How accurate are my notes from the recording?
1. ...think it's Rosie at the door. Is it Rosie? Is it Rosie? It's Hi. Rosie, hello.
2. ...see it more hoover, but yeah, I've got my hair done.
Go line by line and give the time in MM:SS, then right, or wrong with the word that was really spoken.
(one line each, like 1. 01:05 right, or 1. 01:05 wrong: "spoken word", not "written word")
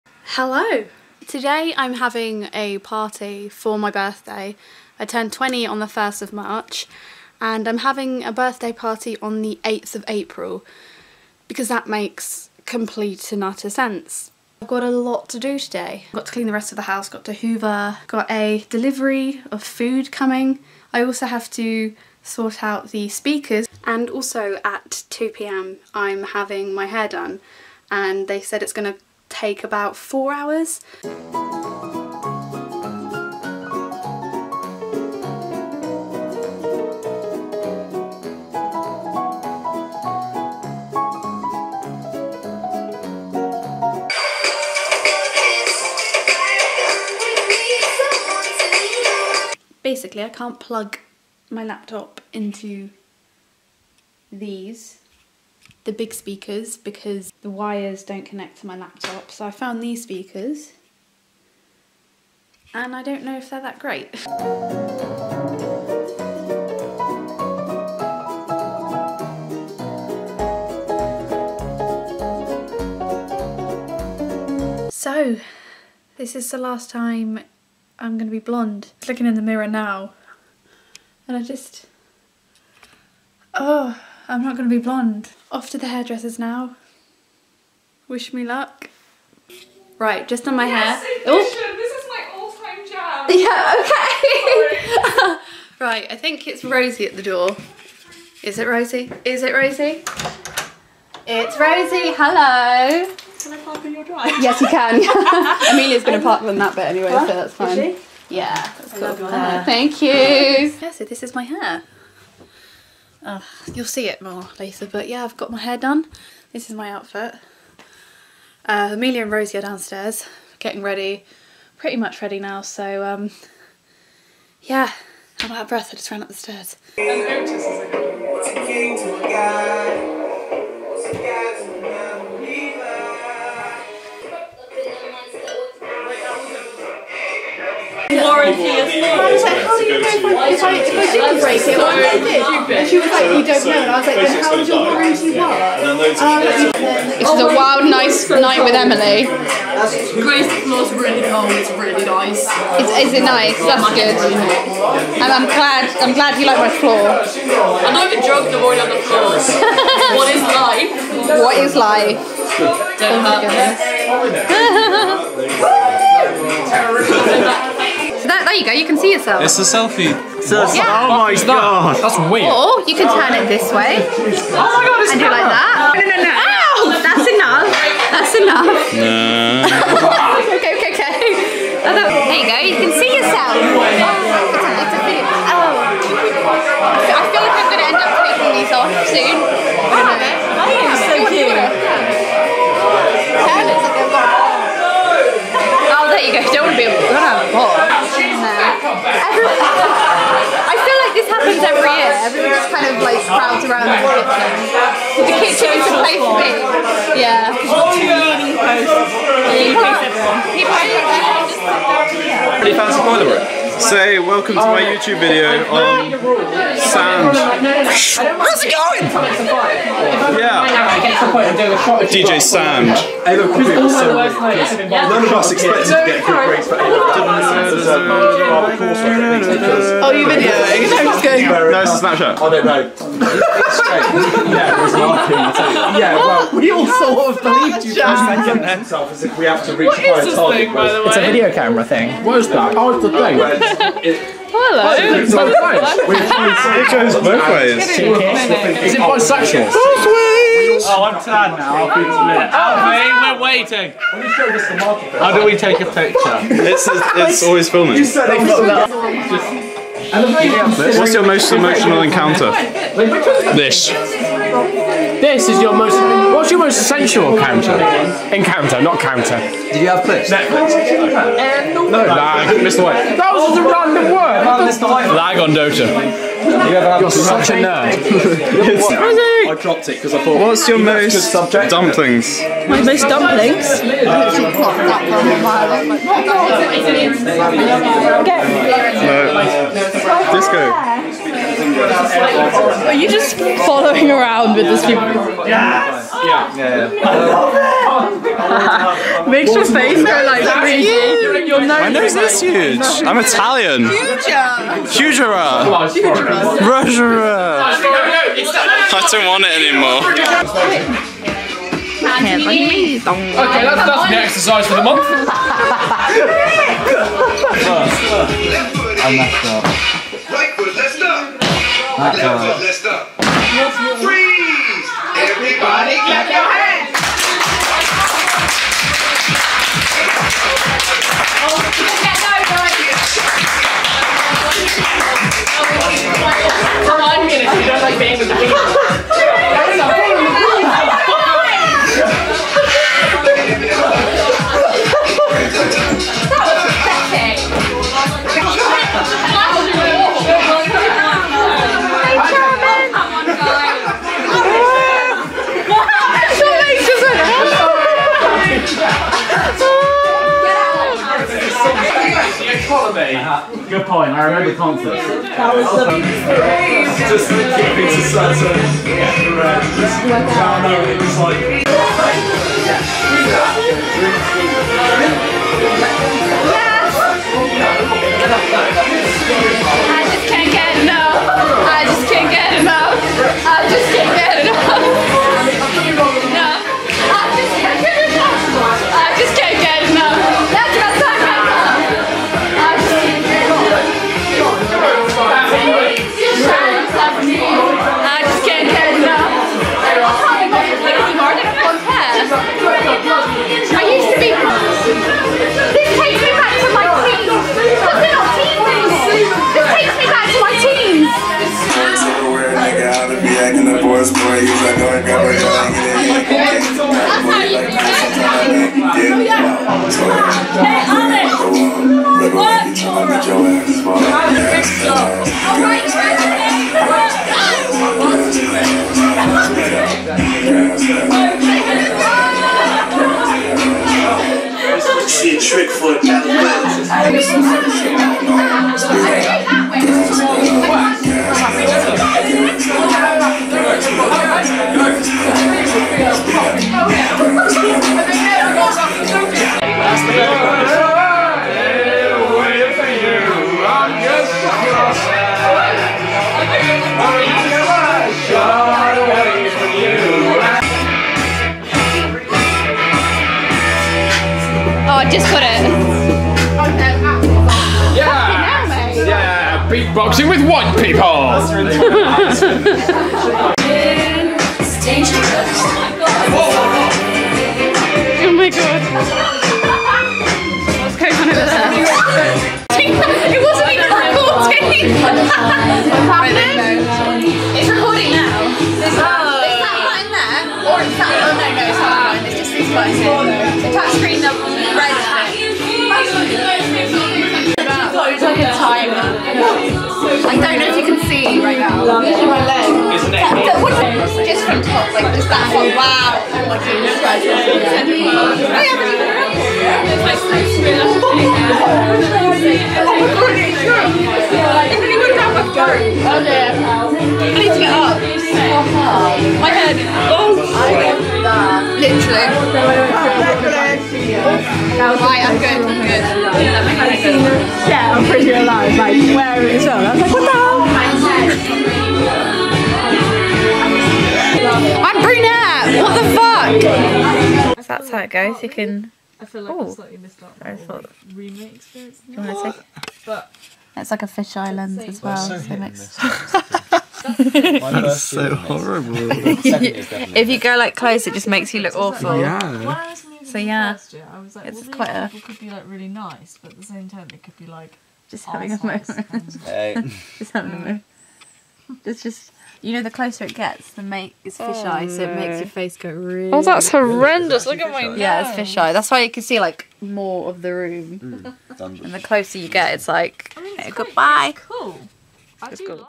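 1. 01:36 right
2. 01:53 wrong: "later", not "hoover".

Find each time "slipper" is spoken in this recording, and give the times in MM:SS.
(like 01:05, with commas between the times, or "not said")
not said.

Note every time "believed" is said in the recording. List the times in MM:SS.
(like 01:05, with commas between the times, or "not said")
03:57.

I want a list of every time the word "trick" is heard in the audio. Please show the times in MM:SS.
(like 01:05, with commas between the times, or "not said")
07:15.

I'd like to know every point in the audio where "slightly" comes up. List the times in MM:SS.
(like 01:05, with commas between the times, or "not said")
08:59.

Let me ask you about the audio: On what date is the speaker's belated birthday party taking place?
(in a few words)
8th of April.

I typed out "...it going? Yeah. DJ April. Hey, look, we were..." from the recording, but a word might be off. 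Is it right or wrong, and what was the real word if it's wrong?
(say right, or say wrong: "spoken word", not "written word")
wrong: "Sand", not "April".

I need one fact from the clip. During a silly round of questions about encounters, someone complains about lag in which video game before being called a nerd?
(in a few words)
Dota.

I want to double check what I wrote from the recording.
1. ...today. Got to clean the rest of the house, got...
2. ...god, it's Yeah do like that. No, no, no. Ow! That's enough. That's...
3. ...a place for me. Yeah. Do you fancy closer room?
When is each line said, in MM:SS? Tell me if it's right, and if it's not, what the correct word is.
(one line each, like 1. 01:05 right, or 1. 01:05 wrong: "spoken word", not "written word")
1. 00:15 right
2. 02:54 wrong: "And", not "Yeah"
3. 03:25 wrong: "boiler", not "closer".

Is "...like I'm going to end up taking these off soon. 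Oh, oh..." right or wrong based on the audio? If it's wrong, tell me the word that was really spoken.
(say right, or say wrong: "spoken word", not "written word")
right.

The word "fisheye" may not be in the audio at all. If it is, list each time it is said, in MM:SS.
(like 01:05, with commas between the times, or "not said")
09:04, 09:24, 09:28.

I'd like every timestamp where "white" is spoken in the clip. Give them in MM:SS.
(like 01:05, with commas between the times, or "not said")
04:32, 07:50.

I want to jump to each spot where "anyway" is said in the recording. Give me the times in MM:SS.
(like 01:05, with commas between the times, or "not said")
01:46.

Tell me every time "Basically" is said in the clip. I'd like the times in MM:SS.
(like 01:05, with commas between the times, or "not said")
00:49.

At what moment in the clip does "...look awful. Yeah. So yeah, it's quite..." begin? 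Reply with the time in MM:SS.
09:11.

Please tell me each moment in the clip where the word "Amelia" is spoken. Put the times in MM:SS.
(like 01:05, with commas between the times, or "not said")
01:45, 01:58.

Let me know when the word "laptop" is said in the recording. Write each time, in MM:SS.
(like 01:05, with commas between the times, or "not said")
00:51, 00:58.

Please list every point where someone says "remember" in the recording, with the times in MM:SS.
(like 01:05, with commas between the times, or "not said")
06:04.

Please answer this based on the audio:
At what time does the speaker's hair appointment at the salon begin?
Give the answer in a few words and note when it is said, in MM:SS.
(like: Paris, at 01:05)
2pm, at 00:25.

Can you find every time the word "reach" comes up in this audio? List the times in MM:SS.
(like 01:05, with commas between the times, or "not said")
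03:59.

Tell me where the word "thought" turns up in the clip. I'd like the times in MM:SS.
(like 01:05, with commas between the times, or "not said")
04:40, 09:00.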